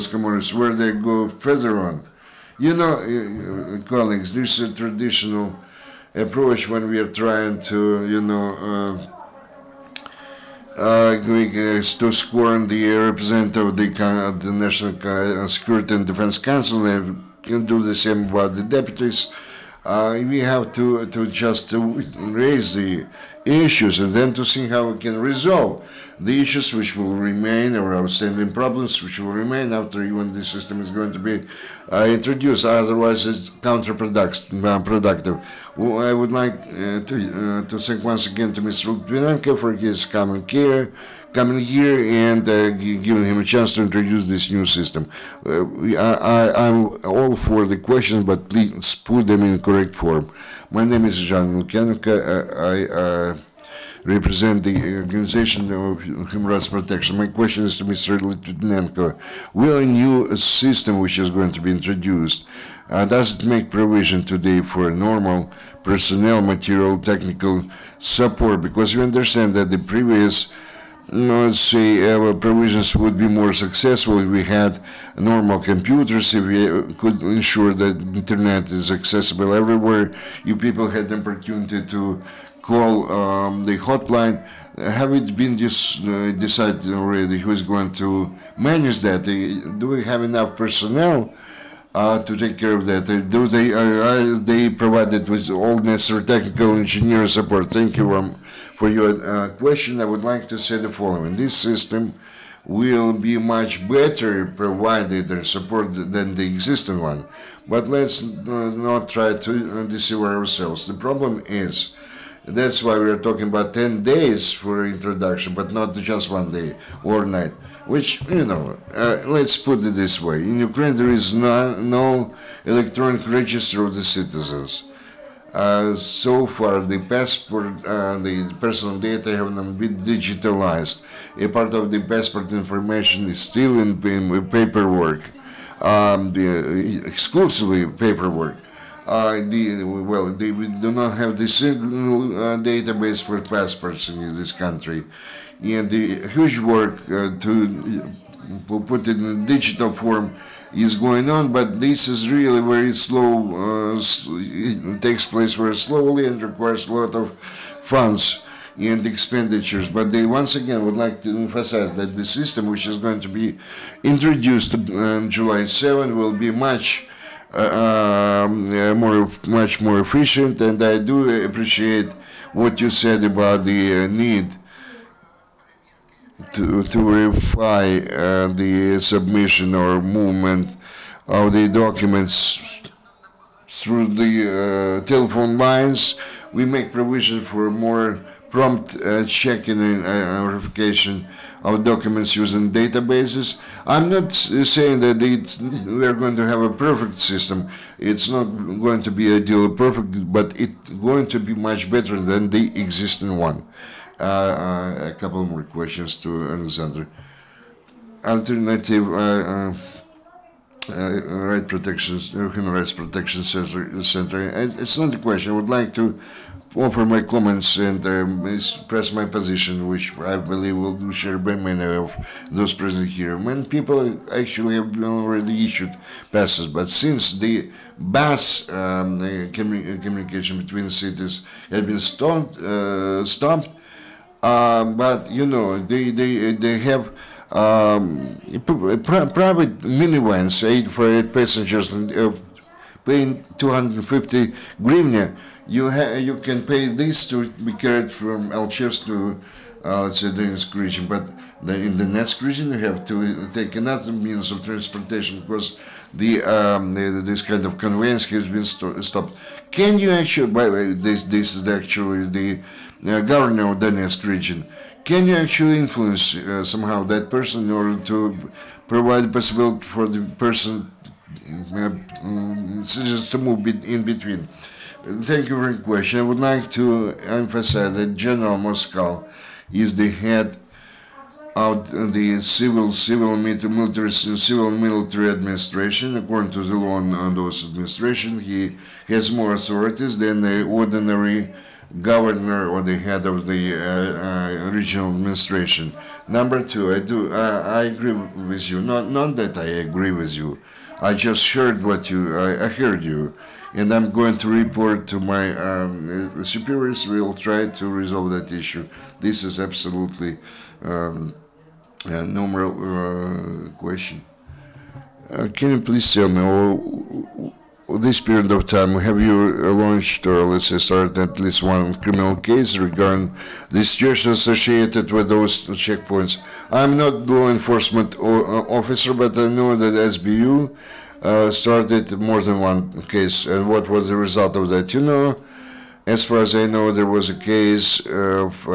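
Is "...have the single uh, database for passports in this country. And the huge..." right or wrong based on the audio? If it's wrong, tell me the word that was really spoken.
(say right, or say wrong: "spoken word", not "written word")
right.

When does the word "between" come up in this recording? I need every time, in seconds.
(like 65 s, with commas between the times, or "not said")
230 s, 274 s.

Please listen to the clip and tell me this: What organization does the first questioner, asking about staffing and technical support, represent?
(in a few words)
Organization of Human Rights Protection.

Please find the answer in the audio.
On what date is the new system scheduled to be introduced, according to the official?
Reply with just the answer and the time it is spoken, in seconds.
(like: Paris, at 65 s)
July 7, at 165 s.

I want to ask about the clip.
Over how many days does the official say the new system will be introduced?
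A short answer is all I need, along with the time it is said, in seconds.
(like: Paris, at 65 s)
10, at 113 s.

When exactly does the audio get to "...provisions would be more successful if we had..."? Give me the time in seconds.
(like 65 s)
72 s.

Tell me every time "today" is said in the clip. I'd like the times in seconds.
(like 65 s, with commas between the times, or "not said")
64 s.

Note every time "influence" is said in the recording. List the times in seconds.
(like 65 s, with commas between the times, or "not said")
265 s.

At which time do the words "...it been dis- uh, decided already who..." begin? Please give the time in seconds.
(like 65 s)
85 s.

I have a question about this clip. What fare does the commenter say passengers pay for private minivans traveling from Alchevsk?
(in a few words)
250 hryvnia.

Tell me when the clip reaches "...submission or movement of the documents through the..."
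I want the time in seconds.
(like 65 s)
179 s.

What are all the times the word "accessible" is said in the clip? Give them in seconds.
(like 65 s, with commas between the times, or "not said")
78 s.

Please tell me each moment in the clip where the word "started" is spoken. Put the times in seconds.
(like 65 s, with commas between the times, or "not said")
320 s, 331 s.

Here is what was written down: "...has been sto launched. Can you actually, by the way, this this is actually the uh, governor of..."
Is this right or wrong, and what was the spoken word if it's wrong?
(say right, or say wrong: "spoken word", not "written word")
wrong: "stopped", not "launched".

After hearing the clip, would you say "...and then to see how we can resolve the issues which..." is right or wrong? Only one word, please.
right.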